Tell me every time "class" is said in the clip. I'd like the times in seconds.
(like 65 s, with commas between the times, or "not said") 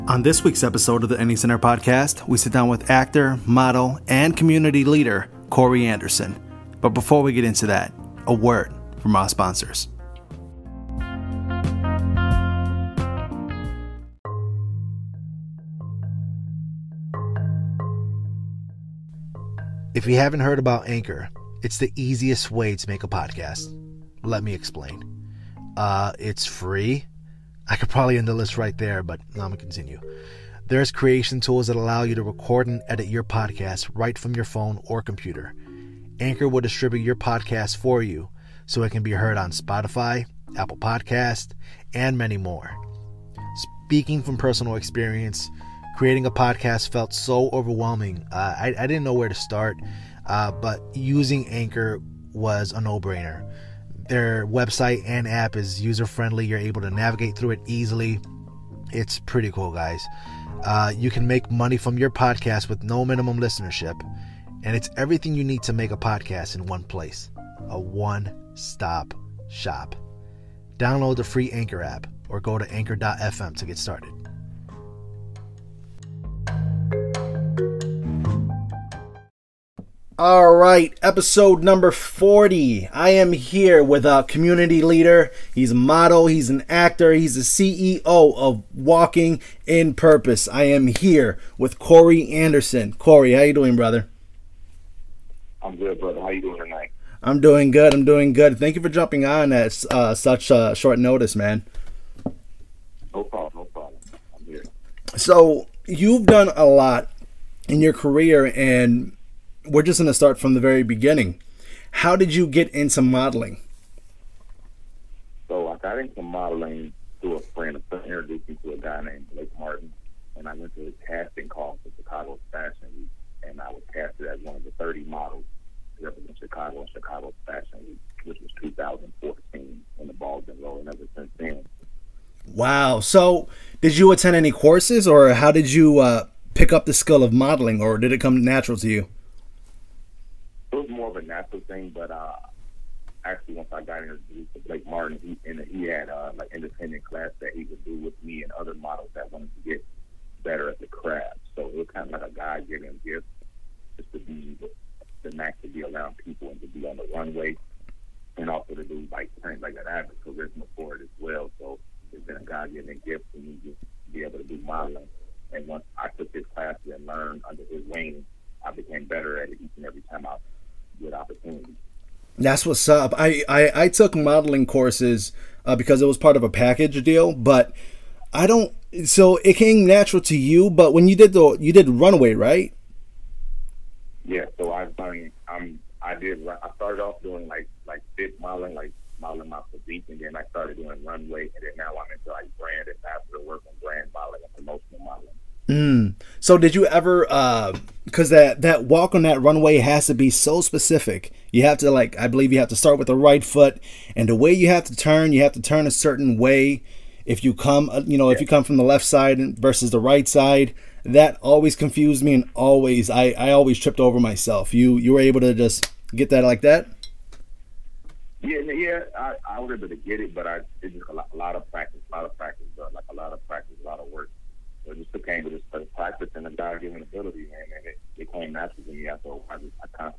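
147 s, 166 s.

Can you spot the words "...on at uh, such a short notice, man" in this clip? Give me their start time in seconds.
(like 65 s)
99 s.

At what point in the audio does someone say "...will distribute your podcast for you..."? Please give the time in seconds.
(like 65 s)
36 s.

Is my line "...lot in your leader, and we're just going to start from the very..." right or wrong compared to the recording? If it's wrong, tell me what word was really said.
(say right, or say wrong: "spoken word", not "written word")
wrong: "career", not "leader".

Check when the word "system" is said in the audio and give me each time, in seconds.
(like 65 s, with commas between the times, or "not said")
not said.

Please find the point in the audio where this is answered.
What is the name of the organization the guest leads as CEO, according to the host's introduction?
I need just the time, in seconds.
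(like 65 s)
88 s.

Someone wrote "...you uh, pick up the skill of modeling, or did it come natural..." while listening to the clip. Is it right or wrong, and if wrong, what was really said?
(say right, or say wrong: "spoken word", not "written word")
right.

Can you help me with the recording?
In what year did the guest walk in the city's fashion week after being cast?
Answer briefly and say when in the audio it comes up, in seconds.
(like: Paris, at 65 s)
2014, at 128 s.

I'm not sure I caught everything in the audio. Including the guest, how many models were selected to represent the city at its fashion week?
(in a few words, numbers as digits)
30.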